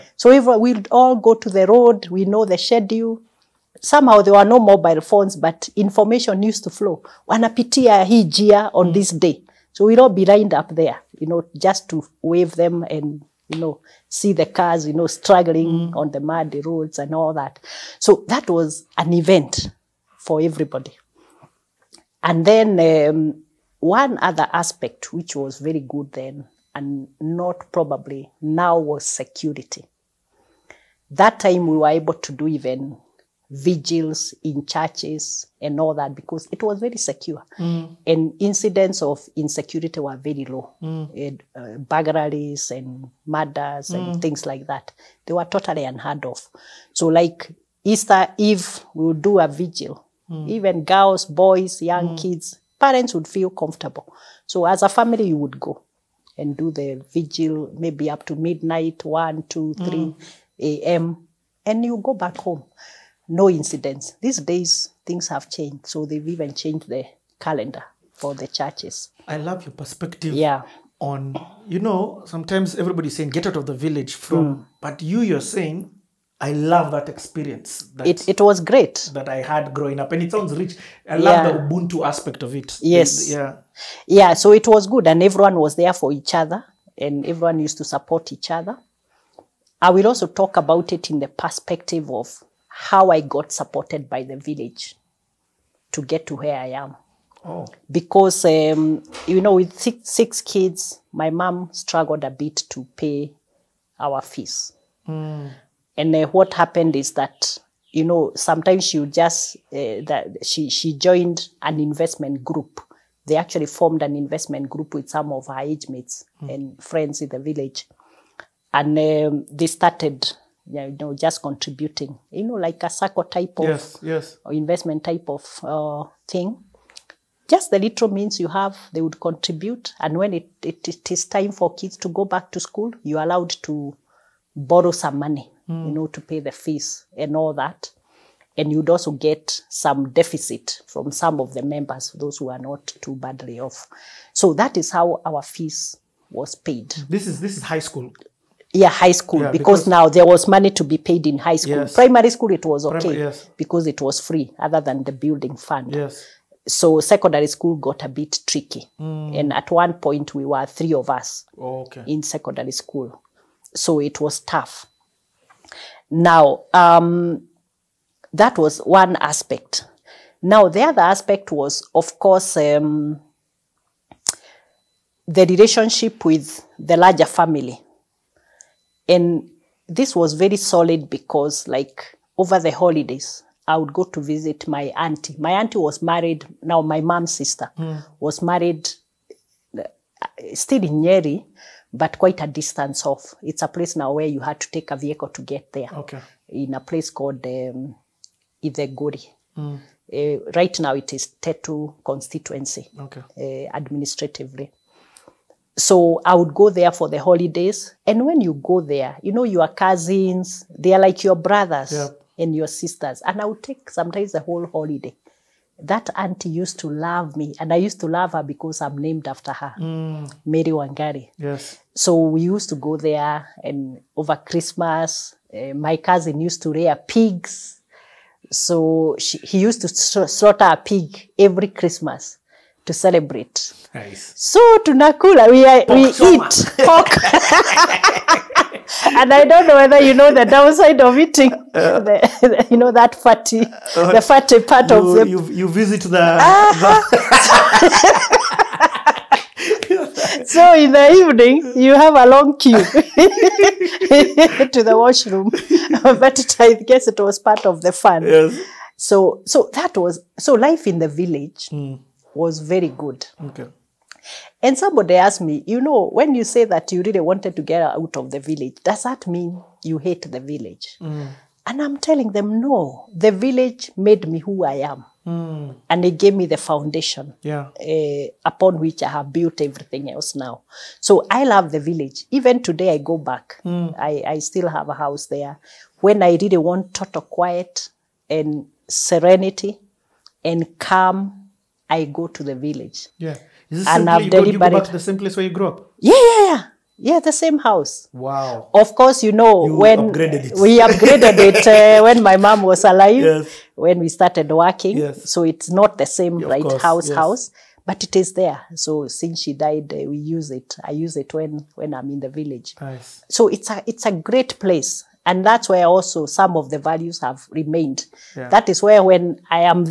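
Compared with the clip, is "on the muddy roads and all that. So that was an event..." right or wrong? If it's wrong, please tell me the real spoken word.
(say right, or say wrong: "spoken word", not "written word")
right.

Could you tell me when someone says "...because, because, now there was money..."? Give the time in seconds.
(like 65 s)
149 s.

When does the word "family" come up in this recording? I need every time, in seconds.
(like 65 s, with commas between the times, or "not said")
54 s, 177 s.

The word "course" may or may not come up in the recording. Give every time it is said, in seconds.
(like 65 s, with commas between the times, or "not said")
172 s, 298 s, 306 s.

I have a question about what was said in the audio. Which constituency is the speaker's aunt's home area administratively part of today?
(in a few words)
Tetu.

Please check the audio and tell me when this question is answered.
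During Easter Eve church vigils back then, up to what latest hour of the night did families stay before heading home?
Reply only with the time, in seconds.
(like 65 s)
59 s.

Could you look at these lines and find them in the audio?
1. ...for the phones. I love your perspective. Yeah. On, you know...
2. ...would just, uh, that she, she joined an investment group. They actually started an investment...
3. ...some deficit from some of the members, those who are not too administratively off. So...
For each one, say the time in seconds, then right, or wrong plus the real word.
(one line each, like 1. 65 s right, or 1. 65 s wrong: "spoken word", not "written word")
1. 68 s wrong: "churches", not "phones"
2. 108 s wrong: "formed", not "started"
3. 139 s wrong: "badly", not "administratively".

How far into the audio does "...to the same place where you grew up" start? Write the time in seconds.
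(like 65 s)
294 s.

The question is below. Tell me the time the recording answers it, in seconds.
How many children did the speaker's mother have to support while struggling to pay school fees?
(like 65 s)
100 s.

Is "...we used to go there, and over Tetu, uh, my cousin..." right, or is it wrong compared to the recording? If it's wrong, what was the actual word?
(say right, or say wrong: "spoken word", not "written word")
wrong: "Christmas", not "Tetu".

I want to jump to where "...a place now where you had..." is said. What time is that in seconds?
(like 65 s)
193 s.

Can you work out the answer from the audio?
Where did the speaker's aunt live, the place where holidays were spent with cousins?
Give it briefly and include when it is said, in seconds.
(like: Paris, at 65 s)
Itheguri, at 198 s.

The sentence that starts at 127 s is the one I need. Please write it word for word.
Just the little means you have, they would contribute.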